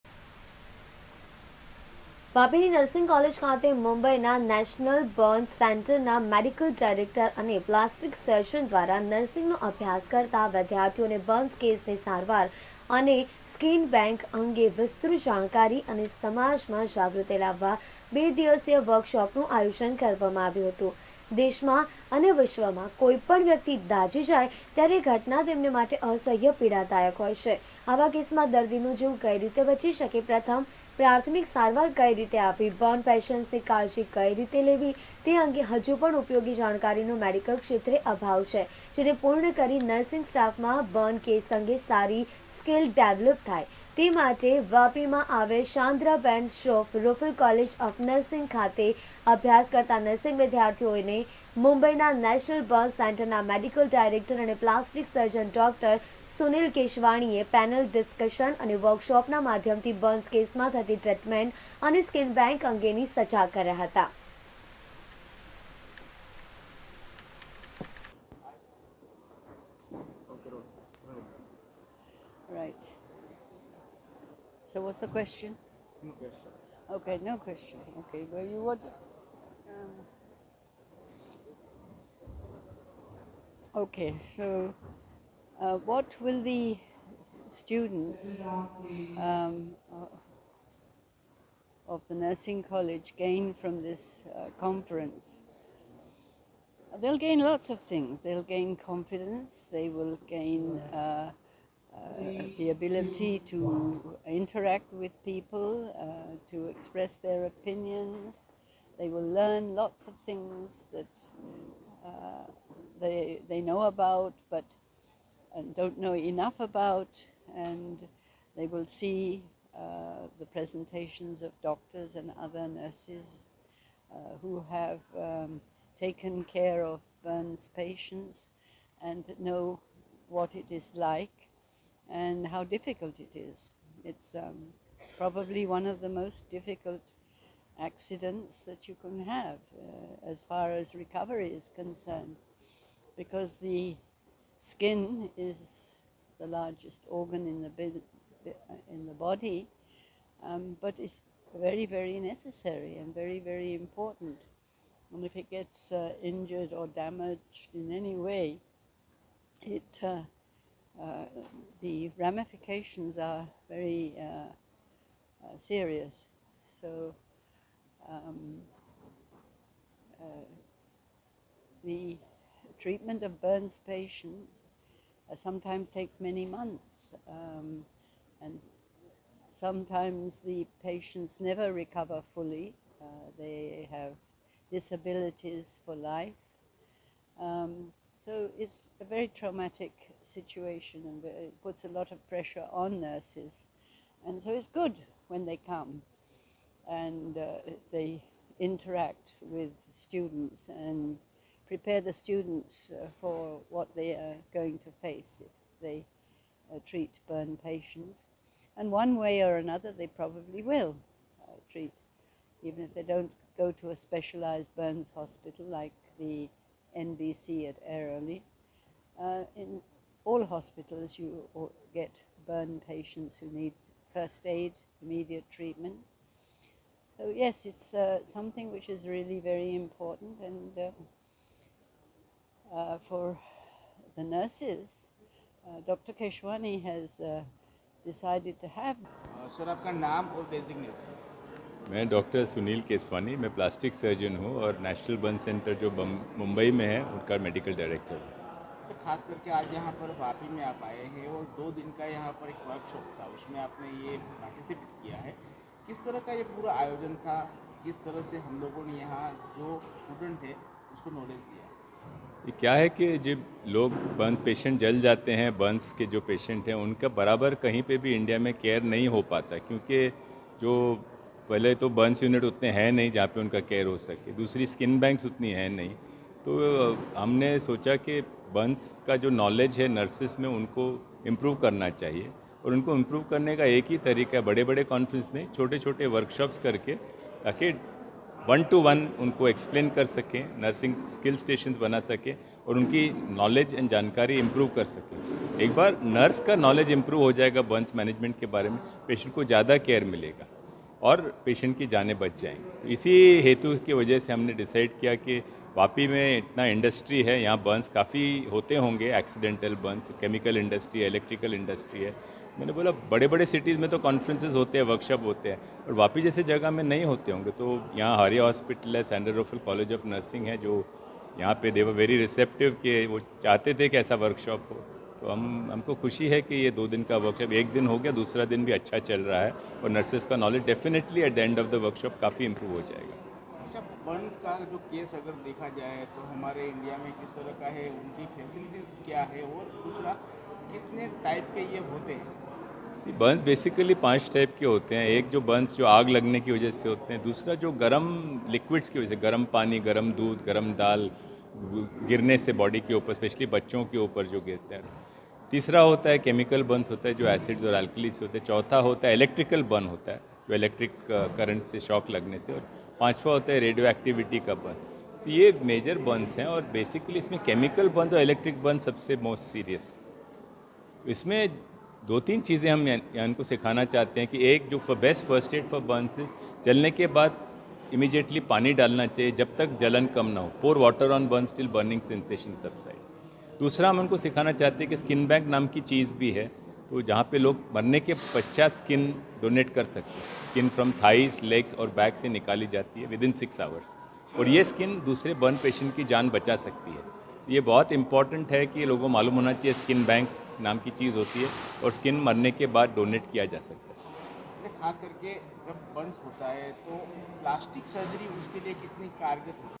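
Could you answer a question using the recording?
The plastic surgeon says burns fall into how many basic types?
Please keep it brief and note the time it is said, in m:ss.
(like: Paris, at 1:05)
5, at 5:44.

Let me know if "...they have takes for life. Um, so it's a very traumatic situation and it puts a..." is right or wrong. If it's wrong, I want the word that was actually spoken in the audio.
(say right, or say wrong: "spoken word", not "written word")
wrong: "disabilities", not "takes".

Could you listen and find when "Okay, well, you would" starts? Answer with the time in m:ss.
1:17.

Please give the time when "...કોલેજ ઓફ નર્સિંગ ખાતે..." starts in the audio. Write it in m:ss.
0:47.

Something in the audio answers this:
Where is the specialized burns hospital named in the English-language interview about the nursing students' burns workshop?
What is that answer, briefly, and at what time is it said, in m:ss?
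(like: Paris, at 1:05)
Airoli, at 3:37.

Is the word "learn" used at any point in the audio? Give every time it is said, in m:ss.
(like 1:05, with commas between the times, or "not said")
1:49.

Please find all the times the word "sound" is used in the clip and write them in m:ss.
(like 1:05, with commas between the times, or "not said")
not said.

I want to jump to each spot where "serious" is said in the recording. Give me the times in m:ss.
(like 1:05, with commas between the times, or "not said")
2:45.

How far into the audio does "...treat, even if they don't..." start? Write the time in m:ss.
3:31.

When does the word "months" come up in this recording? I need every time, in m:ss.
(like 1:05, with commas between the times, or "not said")
2:56.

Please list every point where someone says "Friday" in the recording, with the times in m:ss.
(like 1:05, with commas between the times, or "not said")
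not said.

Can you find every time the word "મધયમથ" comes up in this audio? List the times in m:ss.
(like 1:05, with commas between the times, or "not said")
0:59.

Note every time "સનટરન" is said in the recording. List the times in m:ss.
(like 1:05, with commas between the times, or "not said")
0:05, 0:53.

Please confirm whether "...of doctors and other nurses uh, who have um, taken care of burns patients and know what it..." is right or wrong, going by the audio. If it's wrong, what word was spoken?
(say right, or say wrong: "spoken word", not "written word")
right.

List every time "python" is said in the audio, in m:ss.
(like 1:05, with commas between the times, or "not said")
not said.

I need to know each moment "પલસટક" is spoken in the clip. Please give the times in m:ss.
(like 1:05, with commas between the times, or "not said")
0:07, 0:54.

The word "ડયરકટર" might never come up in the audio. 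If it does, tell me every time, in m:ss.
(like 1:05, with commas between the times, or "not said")
0:06, 0:53.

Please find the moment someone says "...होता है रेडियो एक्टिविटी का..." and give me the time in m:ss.
6:03.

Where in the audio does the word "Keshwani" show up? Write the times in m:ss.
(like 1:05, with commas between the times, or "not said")
3:56.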